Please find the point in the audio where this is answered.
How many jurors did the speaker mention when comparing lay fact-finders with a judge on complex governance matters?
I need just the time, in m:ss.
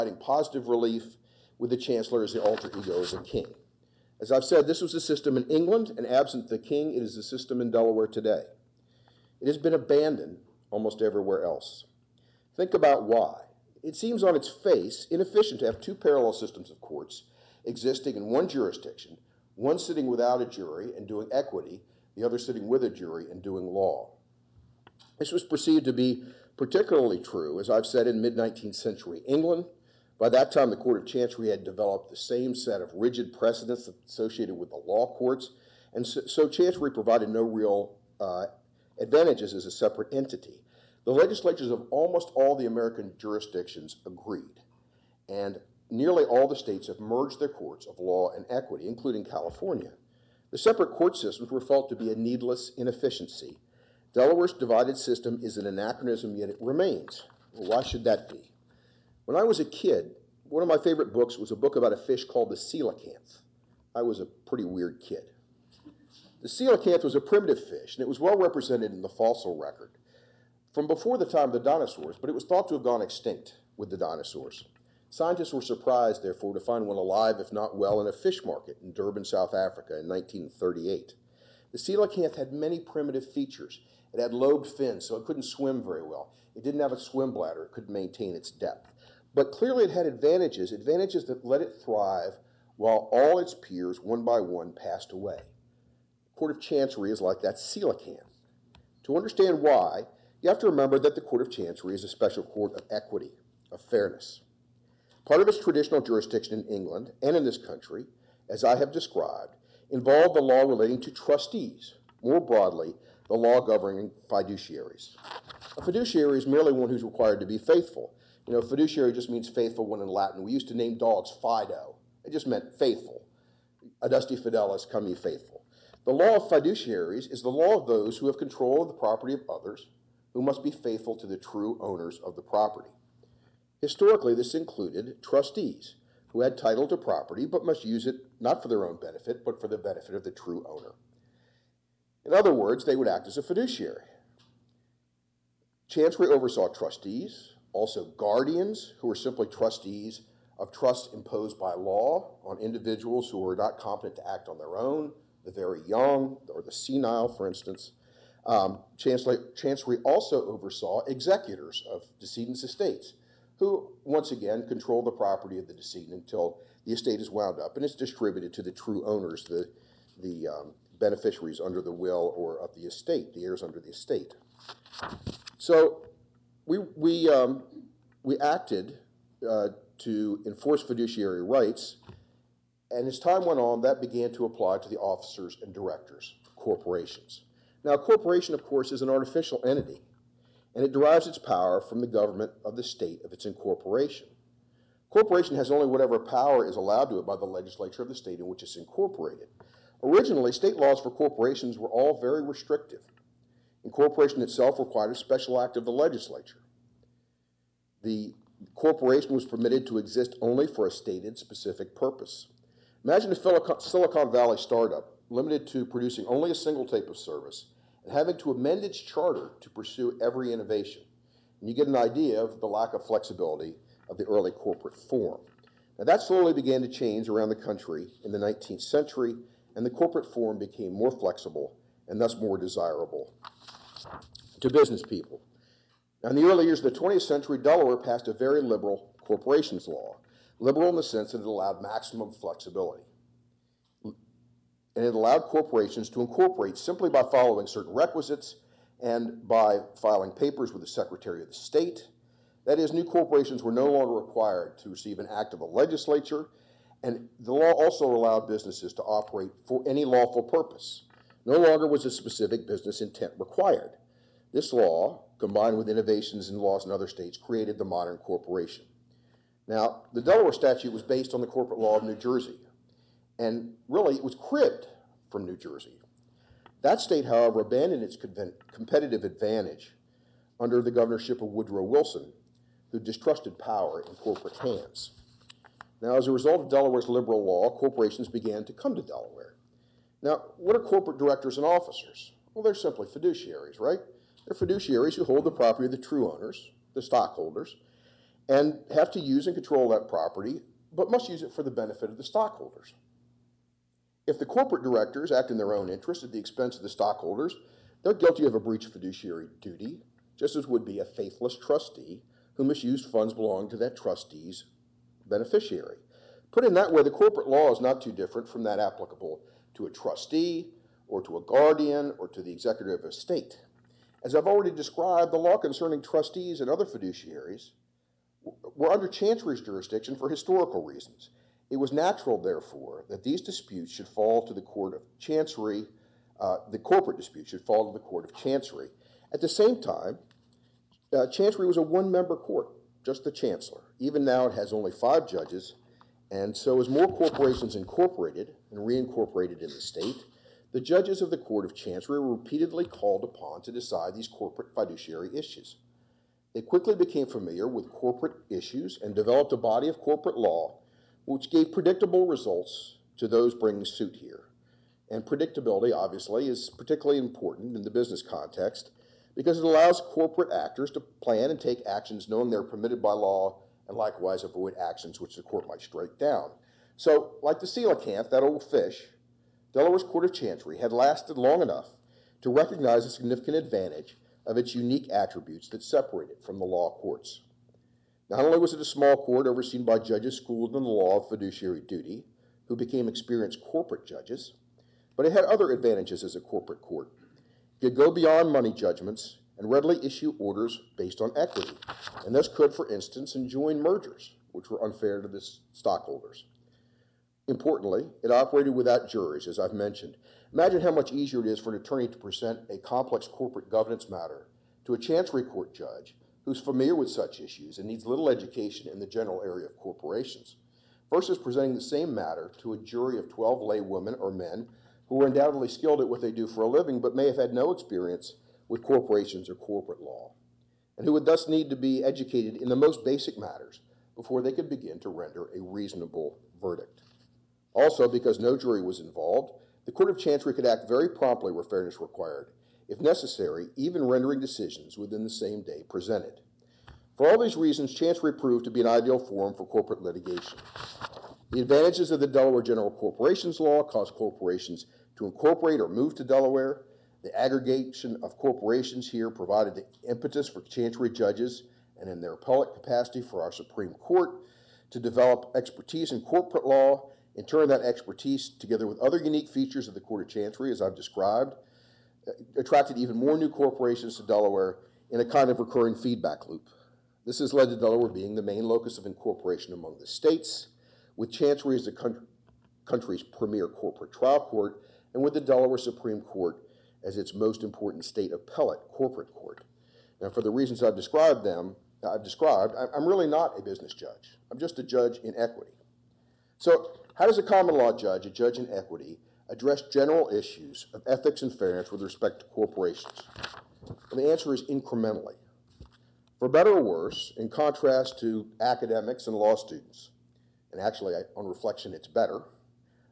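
7:03.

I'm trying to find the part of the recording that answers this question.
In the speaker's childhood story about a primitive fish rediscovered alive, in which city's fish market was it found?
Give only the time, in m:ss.
1:18.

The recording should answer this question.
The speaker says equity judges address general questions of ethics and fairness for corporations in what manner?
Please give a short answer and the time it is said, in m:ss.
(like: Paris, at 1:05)
incrementally, at 8:24.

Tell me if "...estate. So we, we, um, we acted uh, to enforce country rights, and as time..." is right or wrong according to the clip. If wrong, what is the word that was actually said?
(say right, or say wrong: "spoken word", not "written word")
wrong: "fiduciary", not "country".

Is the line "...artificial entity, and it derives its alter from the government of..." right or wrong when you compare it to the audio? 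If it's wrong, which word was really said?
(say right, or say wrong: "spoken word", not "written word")
wrong: "power", not "alter".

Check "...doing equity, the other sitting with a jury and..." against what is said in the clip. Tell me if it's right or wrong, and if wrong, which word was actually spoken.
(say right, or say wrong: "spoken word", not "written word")
right.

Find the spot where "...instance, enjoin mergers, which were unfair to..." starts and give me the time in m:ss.
6:42.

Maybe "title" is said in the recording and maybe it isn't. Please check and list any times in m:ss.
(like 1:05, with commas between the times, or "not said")
2:16.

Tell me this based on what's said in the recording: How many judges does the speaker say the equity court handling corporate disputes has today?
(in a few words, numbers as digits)
5.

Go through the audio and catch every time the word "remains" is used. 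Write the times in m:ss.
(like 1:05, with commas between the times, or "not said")
0:56.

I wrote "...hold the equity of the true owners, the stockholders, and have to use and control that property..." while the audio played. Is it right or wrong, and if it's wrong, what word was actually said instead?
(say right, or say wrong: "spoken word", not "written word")
wrong: "property", not "equity".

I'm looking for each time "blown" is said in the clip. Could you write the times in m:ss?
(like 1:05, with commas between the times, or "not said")
not said.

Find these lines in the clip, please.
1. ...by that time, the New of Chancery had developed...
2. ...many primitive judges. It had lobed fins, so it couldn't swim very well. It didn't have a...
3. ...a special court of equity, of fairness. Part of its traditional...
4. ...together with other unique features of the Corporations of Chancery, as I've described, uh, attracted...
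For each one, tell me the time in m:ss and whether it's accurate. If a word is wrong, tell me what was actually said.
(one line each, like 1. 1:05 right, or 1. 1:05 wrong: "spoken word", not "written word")
1. 0:30 wrong: "Court", not "New"
2. 1:22 wrong: "features", not "judges"
3. 1:42 right
4. 7:48 wrong: "Court", not "Corporations".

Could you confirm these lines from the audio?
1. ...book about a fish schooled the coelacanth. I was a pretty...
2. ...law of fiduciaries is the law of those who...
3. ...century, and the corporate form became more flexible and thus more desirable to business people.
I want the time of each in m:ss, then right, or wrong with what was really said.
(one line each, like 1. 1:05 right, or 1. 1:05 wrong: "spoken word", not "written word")
1. 1:01 wrong: "called", not "schooled"
2. 2:06 right
3. 3:48 right.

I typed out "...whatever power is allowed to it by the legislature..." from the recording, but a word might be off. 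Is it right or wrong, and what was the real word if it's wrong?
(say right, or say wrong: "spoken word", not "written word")
right.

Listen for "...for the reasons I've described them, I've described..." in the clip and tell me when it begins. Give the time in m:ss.
8:10.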